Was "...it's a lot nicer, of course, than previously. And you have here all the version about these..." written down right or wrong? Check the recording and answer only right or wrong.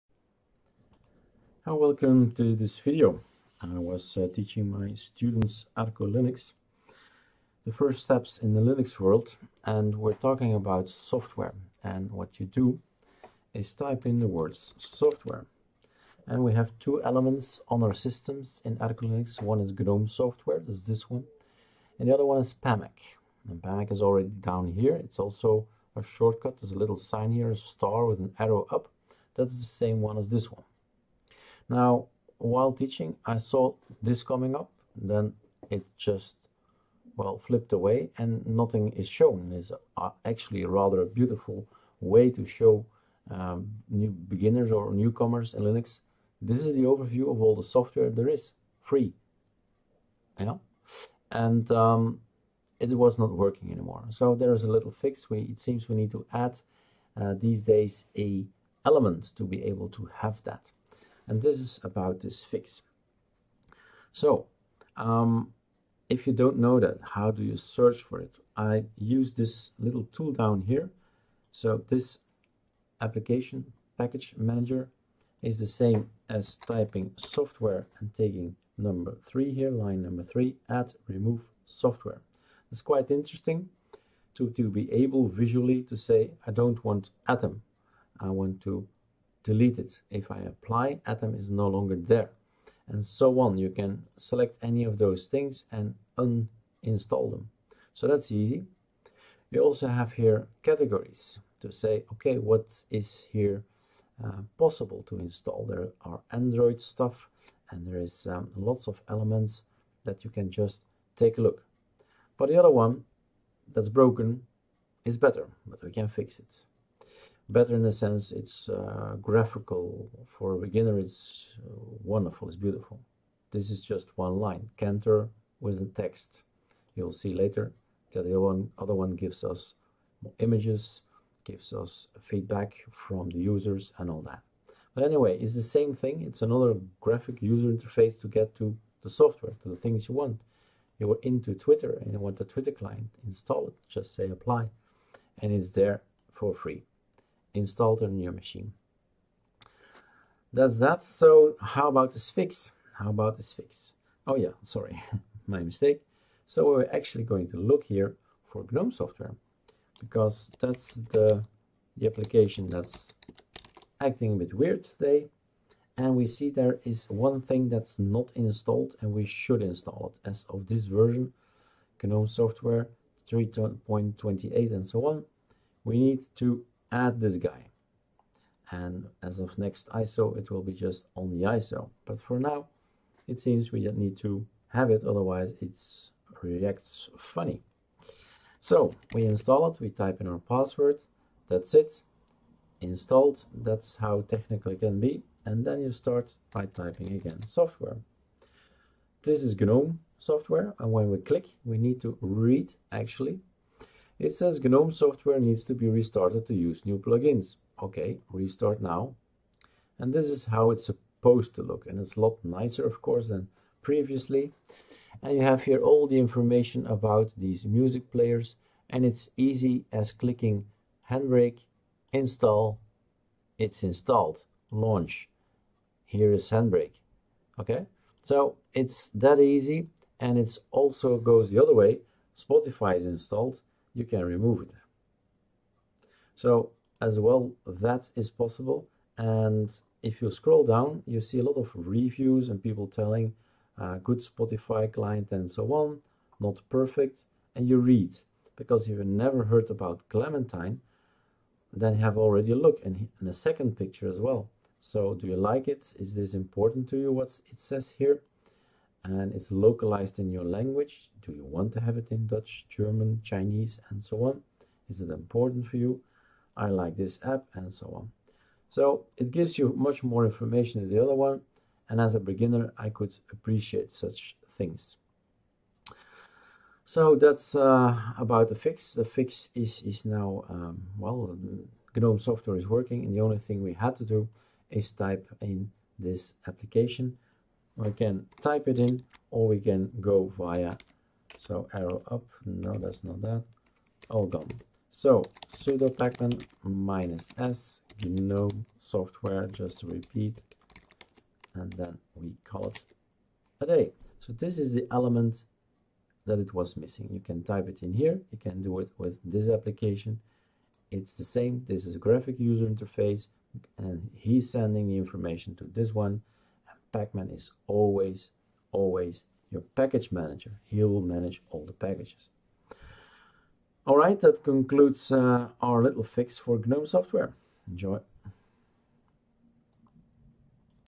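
wrong.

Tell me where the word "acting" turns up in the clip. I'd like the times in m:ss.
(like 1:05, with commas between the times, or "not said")
2:43.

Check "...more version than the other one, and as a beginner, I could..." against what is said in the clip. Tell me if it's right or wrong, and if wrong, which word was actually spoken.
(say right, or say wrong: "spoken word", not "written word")
wrong: "information", not "version".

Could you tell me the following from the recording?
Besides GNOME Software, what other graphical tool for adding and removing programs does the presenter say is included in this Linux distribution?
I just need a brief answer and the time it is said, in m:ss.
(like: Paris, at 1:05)
Pamac, at 0:22.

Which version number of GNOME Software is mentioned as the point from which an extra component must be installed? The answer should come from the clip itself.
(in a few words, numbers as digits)
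3.28.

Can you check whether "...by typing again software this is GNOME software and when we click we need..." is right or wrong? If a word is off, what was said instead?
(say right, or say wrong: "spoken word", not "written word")
right.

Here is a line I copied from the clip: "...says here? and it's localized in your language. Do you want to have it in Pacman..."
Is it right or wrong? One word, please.
wrong.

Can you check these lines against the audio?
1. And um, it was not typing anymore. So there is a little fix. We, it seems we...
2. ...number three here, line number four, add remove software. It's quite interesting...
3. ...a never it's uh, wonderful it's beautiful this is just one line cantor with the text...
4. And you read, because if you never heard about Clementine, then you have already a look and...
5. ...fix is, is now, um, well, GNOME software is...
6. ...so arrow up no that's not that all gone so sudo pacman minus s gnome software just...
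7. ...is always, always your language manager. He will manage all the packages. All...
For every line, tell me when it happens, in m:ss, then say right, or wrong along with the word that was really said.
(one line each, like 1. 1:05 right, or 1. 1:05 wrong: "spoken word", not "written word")
1. 0:51 wrong: "working", not "typing"
2. 1:18 wrong: "three", not "four"
3. 2:00 wrong: "beginner", not "never"
4. 4:07 right
5. 4:39 right
6. 4:51 right
7. 5:17 wrong: "package", not "language".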